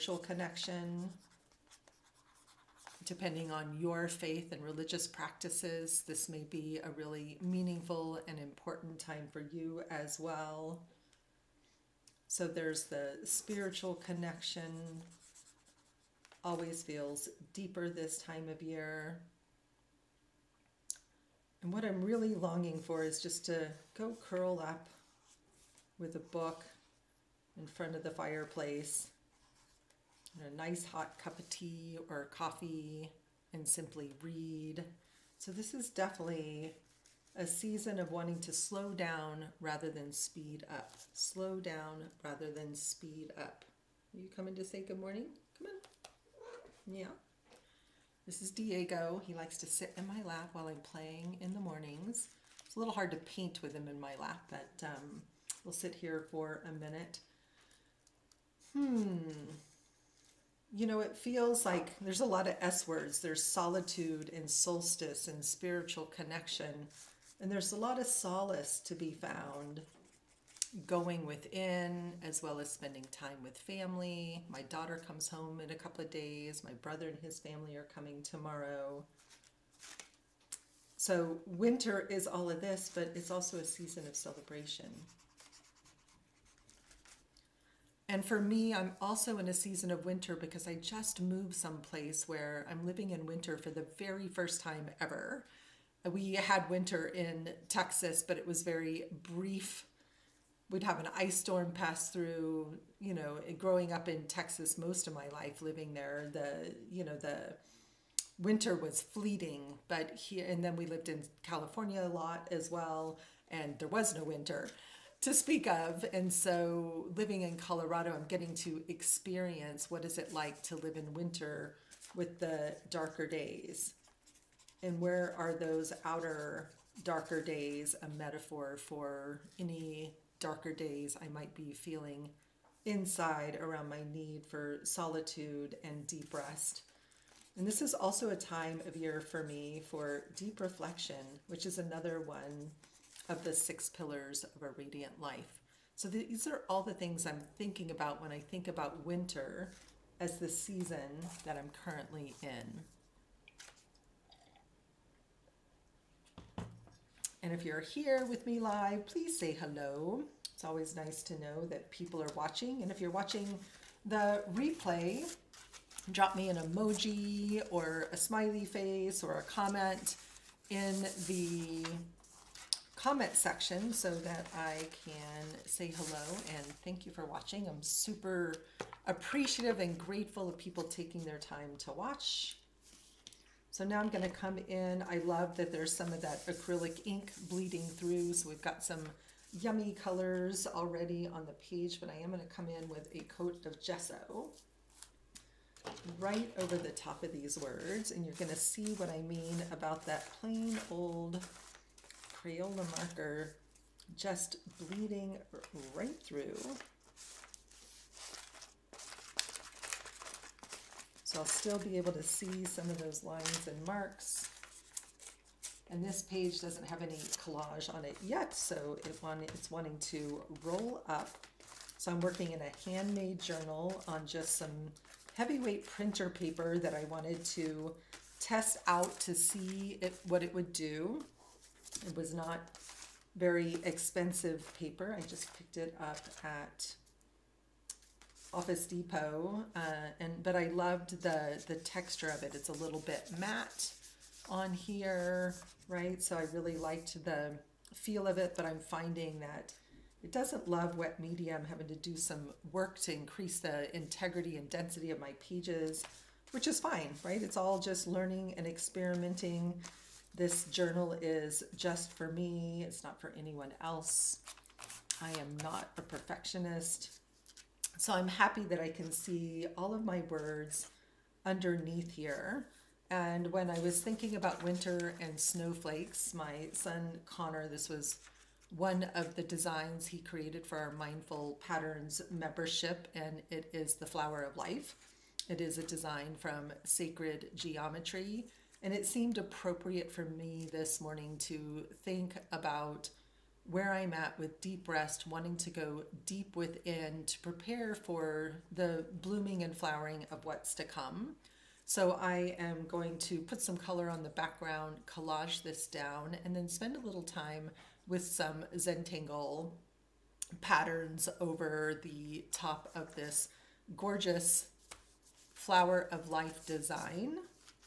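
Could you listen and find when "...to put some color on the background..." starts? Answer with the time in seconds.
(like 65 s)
303 s.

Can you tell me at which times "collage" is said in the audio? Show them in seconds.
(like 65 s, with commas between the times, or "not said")
217 s, 305 s.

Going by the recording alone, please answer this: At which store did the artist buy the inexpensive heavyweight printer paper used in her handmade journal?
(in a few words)
Office Depot.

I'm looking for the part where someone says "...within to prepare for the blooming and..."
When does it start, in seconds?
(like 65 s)
296 s.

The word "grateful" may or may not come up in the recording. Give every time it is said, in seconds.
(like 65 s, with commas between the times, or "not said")
179 s.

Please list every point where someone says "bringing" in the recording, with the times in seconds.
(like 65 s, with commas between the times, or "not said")
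not said.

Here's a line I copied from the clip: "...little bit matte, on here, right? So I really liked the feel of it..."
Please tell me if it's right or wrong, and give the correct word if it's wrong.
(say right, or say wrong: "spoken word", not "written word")
right.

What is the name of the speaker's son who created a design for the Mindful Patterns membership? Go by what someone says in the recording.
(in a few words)
Connor.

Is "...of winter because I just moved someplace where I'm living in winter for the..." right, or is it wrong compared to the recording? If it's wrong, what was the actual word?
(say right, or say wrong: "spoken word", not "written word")
right.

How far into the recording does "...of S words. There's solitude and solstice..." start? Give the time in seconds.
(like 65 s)
62 s.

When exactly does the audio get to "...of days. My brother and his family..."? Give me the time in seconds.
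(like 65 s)
76 s.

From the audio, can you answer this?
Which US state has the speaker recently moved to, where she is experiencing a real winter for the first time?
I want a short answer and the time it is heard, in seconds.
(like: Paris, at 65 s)
Colorado, at 117 s.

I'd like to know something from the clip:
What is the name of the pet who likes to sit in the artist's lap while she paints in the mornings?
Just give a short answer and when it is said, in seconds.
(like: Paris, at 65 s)
Diego, at 48 s.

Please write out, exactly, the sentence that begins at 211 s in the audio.
So I'll still be able to see some of those lines and marks.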